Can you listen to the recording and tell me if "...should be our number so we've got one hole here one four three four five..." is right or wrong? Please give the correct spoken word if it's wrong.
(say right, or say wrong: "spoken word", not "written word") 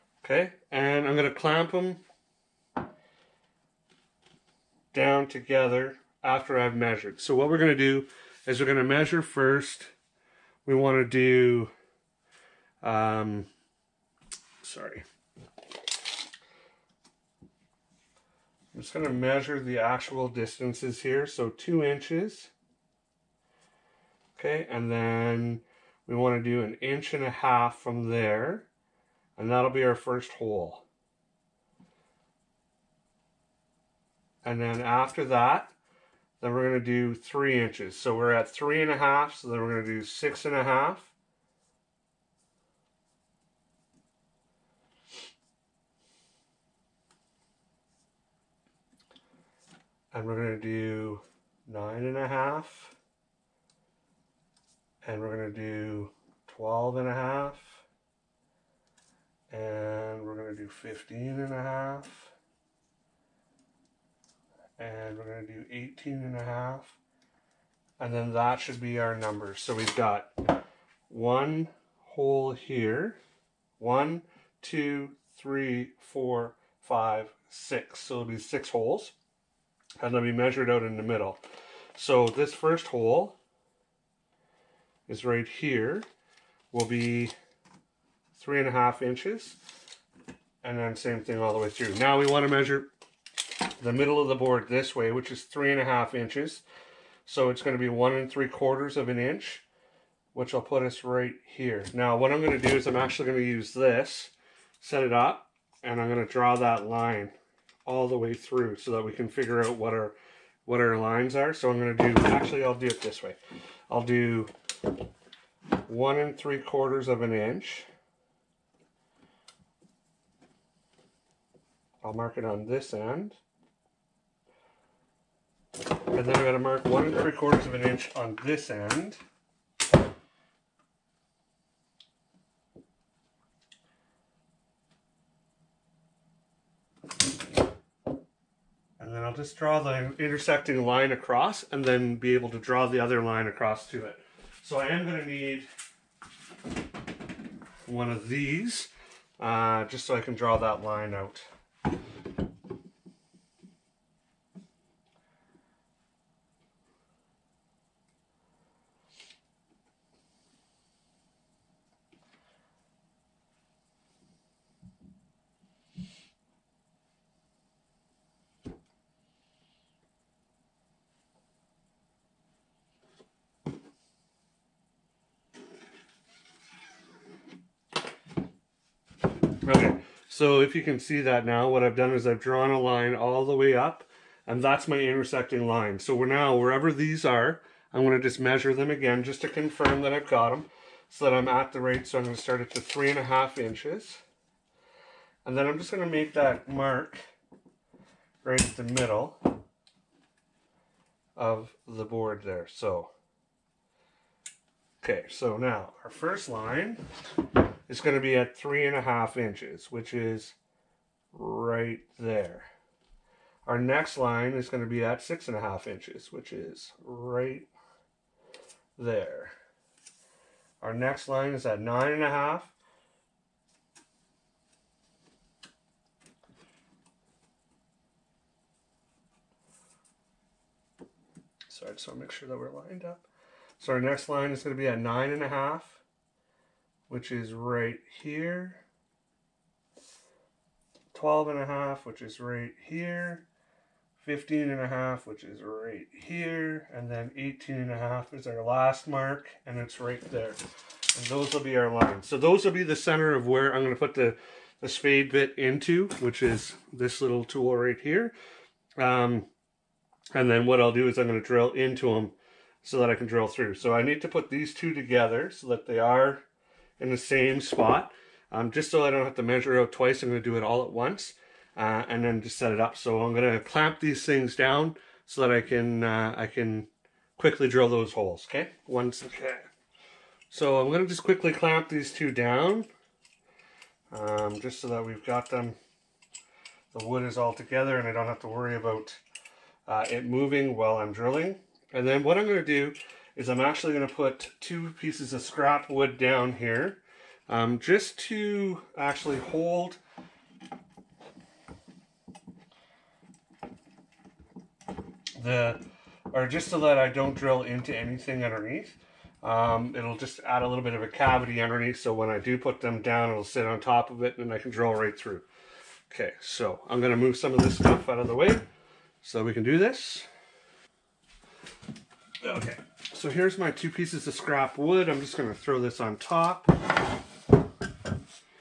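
wrong: "two", not "four".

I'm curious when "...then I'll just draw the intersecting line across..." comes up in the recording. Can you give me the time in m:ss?
2:18.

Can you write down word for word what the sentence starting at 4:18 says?
Um, and then what I'll do is I'm going to drill into them so that I can drill through.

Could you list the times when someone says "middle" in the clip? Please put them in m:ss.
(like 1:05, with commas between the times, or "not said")
1:21, 1:33, 3:18.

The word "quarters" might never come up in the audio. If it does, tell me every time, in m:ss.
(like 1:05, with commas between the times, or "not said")
1:38, 1:56, 2:07.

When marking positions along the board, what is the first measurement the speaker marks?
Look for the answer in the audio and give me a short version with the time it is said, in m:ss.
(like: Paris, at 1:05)
2 inches, at 0:21.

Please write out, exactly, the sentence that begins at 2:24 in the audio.
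So I am going to need one of these uh, just so I can draw that line out.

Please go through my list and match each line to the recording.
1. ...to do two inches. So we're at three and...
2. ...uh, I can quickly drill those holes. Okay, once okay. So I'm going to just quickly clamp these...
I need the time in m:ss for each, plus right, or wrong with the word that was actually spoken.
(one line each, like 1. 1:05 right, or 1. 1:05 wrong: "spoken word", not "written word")
1. 0:36 wrong: "three", not "two"
2. 4:36 right.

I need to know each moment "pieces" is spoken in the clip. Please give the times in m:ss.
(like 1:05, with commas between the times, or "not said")
4:54, 5:23.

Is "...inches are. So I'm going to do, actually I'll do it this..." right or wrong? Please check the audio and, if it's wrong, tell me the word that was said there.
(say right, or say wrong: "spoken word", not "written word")
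wrong: "lines", not "inches".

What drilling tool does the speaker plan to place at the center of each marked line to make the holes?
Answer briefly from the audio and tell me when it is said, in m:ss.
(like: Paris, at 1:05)
spade bit, at 4:14.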